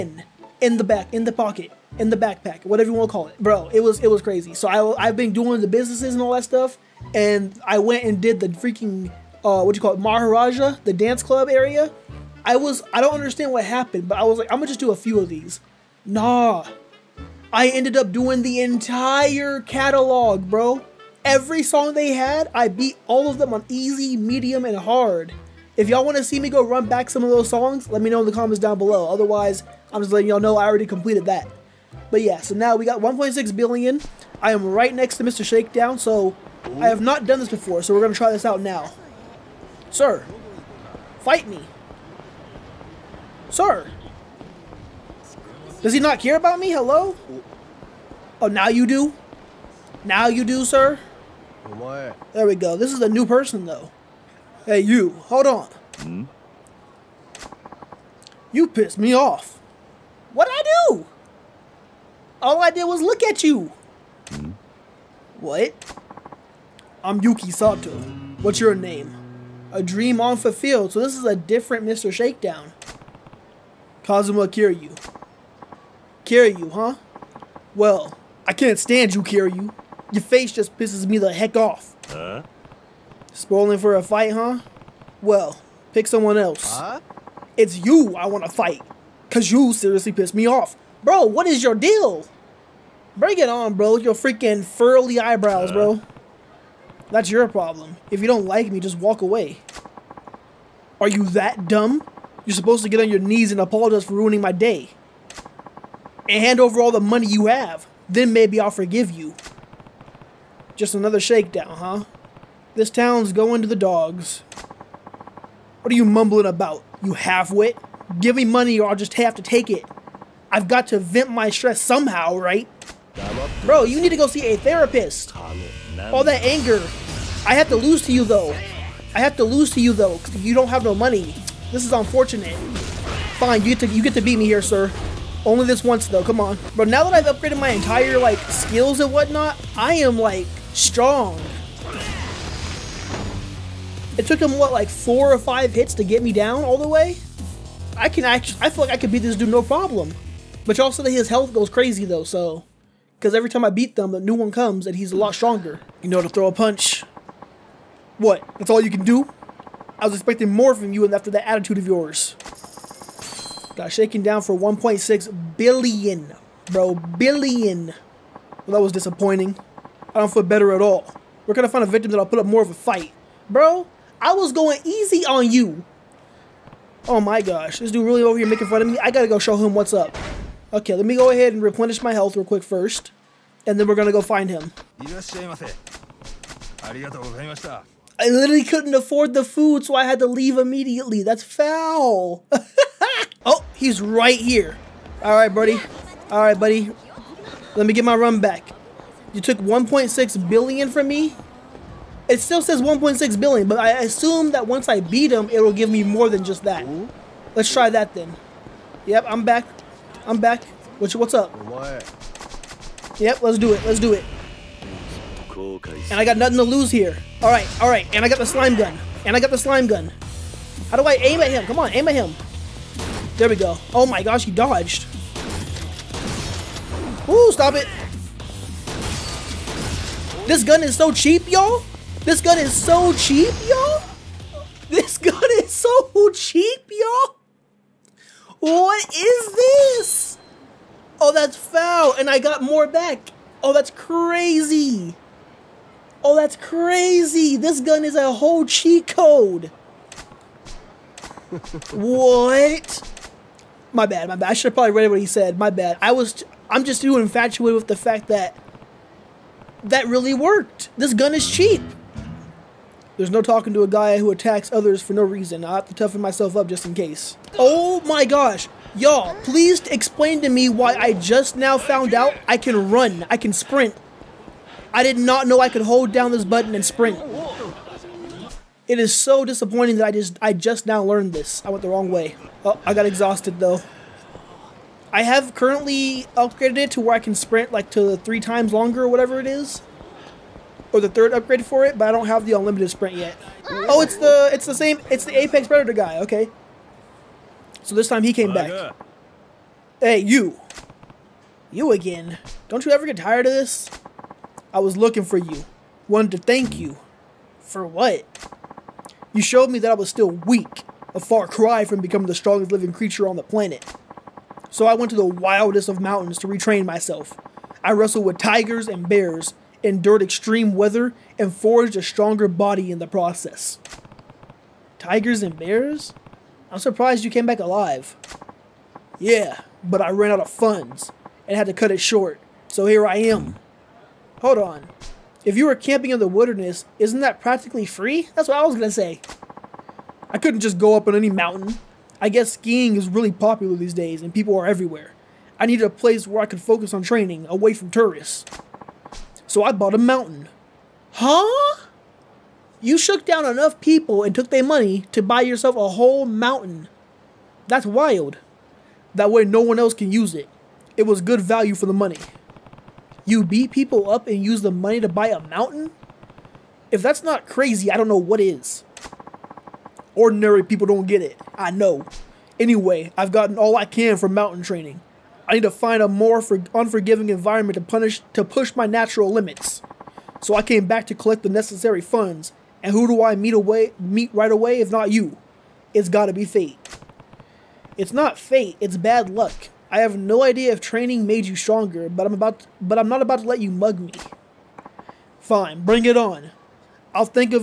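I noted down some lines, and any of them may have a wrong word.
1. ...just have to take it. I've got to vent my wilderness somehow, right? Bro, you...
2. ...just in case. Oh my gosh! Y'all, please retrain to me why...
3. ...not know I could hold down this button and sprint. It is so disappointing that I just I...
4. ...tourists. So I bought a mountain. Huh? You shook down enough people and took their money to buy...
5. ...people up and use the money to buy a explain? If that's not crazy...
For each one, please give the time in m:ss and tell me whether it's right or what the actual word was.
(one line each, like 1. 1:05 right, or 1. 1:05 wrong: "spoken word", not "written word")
1. 1:58 wrong: "stress", not "wilderness"
2. 4:26 wrong: "explain", not "retrain"
3. 4:35 right
4. 5:47 right
5. 6:03 wrong: "mountain", not "explain".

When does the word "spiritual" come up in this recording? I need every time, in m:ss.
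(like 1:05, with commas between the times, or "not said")
not said.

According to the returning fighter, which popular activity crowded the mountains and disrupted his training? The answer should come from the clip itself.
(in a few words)
Skiing.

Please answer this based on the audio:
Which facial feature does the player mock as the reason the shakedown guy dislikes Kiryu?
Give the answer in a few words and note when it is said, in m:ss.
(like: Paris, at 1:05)
Eyebrows, at 1:35.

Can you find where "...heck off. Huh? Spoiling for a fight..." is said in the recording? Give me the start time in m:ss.
1:21.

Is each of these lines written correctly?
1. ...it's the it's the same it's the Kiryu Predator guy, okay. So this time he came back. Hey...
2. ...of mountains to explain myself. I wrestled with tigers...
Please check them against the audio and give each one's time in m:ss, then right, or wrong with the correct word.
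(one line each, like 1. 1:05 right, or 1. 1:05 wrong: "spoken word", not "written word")
1. 4:53 wrong: "Apex", not "Kiryu"
2. 5:15 wrong: "retrain", not "explain".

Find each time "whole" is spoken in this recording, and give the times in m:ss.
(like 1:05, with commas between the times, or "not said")
4:08, 5:55.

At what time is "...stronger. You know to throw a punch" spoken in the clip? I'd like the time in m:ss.
2:35.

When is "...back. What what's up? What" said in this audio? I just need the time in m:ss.
3:30.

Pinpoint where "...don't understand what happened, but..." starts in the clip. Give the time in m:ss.
0:13.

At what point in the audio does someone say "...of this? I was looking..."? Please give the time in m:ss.
5:03.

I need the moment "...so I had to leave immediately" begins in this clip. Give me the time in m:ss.
3:09.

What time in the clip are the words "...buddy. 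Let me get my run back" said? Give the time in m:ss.
3:16.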